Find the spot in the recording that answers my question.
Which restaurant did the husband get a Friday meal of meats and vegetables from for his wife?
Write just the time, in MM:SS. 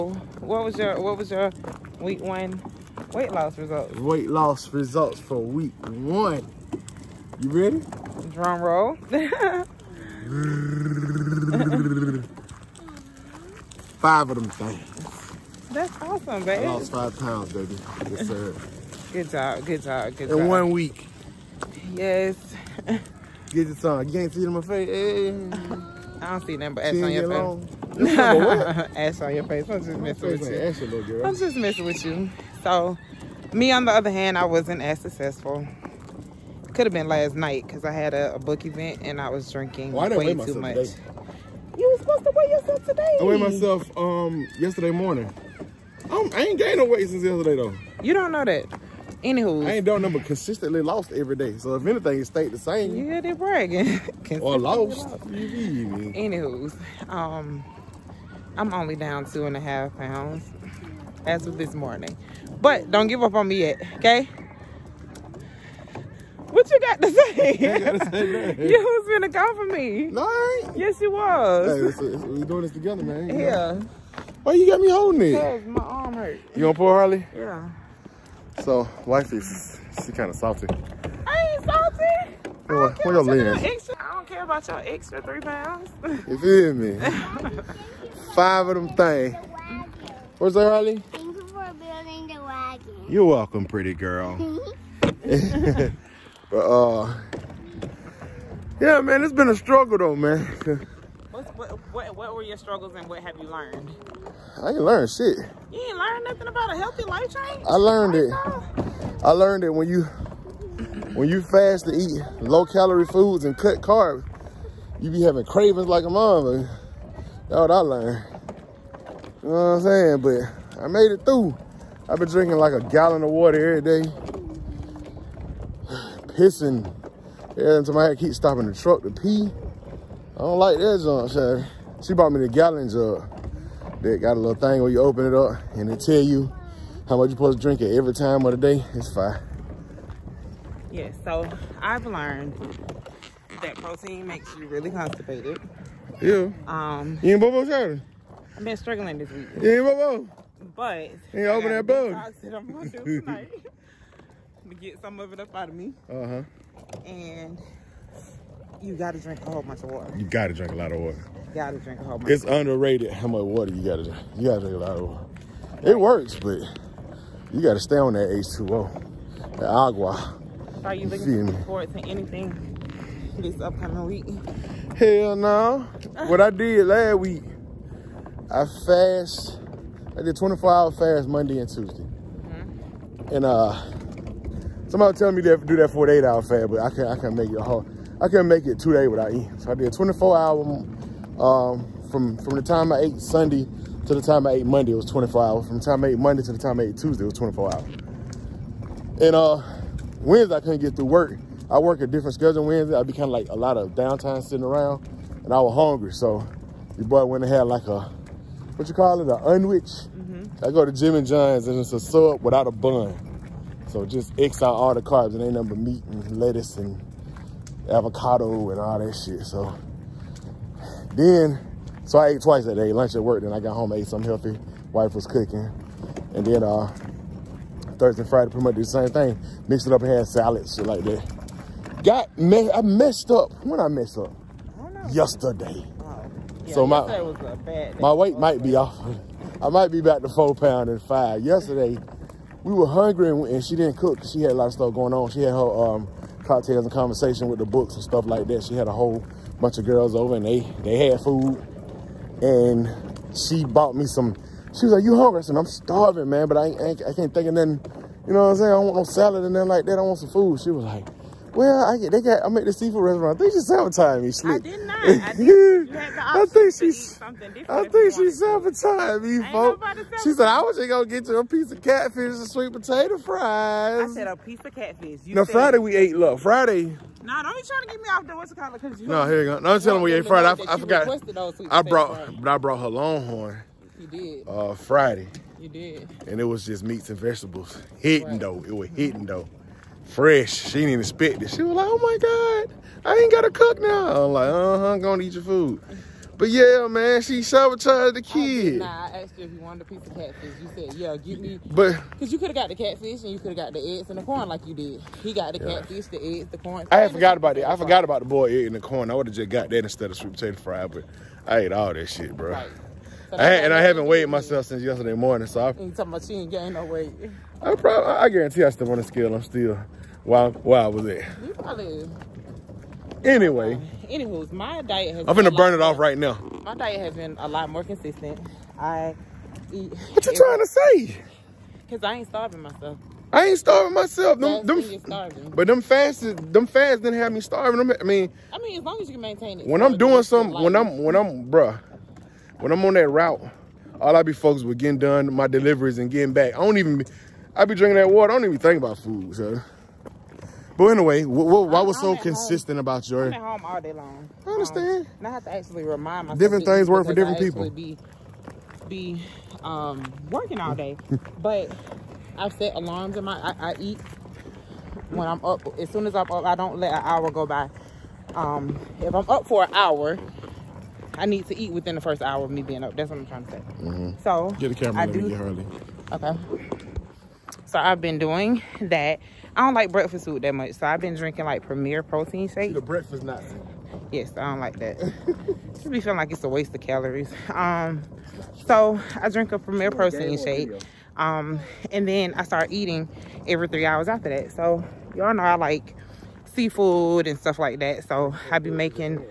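04:42.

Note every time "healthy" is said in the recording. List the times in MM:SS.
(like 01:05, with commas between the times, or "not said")
01:46, 03:44.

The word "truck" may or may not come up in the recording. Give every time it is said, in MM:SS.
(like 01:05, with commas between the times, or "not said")
02:08.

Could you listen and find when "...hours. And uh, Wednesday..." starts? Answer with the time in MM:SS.
03:17.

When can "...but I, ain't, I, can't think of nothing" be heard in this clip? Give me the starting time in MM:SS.
04:16.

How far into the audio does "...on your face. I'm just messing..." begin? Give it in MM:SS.
00:29.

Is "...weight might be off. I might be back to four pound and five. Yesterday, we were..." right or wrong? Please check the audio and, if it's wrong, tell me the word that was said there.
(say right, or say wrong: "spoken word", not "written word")
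right.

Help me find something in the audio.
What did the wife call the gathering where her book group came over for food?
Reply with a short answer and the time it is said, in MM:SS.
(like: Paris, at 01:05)
cocktails and conversation, at 04:06.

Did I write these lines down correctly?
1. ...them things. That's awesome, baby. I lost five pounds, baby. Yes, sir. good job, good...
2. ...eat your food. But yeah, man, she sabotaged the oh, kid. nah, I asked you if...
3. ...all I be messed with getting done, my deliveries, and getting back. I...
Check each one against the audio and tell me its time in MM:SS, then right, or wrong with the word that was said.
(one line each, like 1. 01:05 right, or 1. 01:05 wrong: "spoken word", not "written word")
1. 00:14 right
2. 04:55 right
3. 05:44 wrong: "focused", not "messed".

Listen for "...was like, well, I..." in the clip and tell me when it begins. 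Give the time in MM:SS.
04:20.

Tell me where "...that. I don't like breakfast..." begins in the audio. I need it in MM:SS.
06:18.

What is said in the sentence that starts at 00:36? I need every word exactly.
Could have been last night because I had a, a, book event and I was drinking well, way too much.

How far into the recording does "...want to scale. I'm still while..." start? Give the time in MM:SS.
05:18.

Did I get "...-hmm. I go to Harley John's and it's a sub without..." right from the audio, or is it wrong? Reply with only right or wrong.
wrong.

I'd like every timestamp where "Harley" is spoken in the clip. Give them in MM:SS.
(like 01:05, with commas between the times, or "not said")
01:16, 06:15.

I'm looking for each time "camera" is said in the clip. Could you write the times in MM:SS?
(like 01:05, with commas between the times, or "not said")
06:14.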